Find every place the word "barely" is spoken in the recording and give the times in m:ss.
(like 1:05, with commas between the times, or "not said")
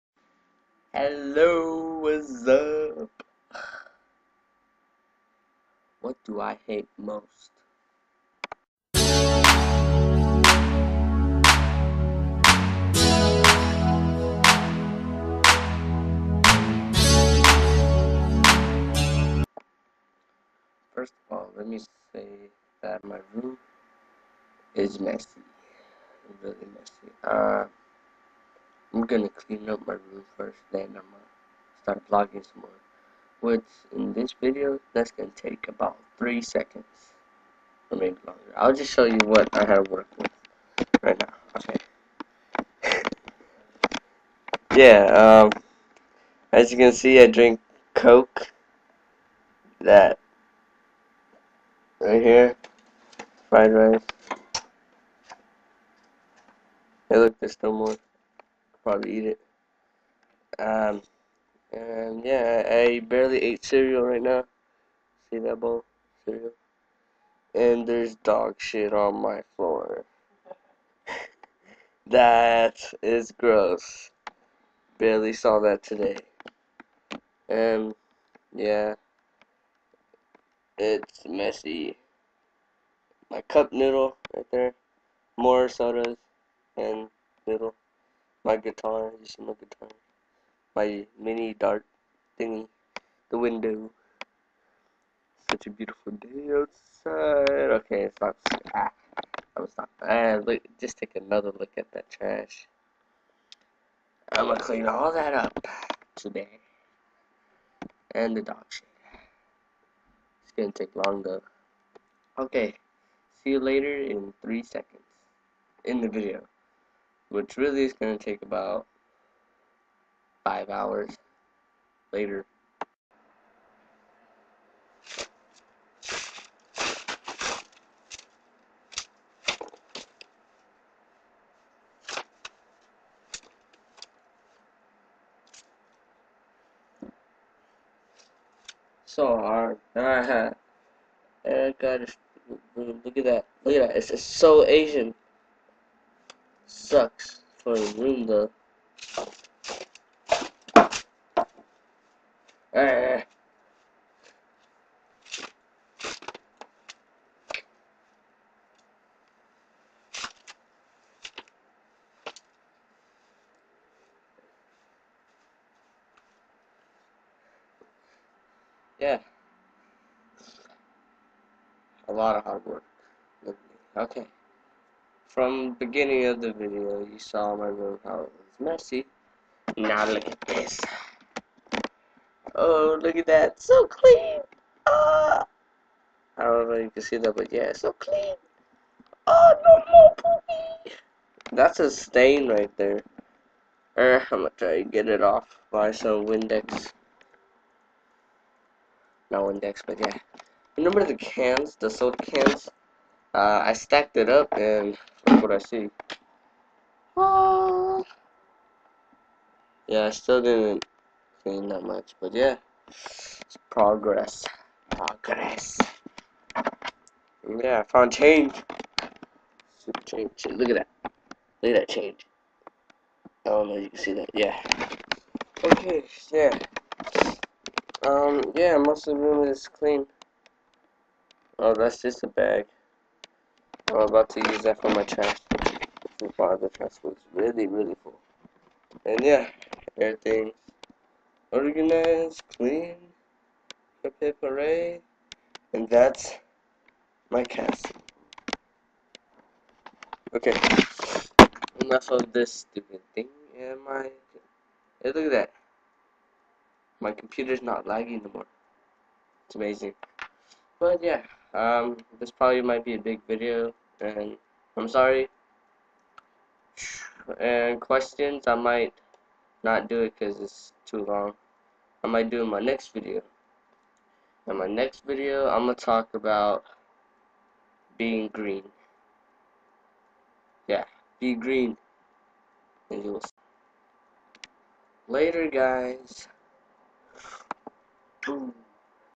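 1:02, 1:14.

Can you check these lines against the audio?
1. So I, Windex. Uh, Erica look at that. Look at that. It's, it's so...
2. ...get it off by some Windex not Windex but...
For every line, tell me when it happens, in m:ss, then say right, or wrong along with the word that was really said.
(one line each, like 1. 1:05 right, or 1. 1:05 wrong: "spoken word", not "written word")
1. 2:19 wrong: "Alright", not "Windex"
2. 3:14 right.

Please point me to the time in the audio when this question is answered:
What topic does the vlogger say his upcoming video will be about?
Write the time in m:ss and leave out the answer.
4:37.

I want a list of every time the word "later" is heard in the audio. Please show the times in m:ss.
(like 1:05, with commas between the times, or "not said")
1:53, 2:02, 4:45.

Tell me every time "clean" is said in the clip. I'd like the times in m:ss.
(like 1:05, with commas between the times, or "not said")
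0:29, 1:44, 3:03, 3:07, 3:31, 3:49, 4:02.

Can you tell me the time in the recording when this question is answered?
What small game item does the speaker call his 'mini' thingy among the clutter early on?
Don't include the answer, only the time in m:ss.
1:31.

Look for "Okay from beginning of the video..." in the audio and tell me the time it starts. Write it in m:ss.
2:53.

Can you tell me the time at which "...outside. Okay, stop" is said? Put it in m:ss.
1:36.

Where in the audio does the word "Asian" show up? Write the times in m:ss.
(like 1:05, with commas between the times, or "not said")
2:24.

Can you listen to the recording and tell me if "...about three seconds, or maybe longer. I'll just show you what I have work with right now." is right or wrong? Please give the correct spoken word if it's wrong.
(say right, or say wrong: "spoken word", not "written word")
right.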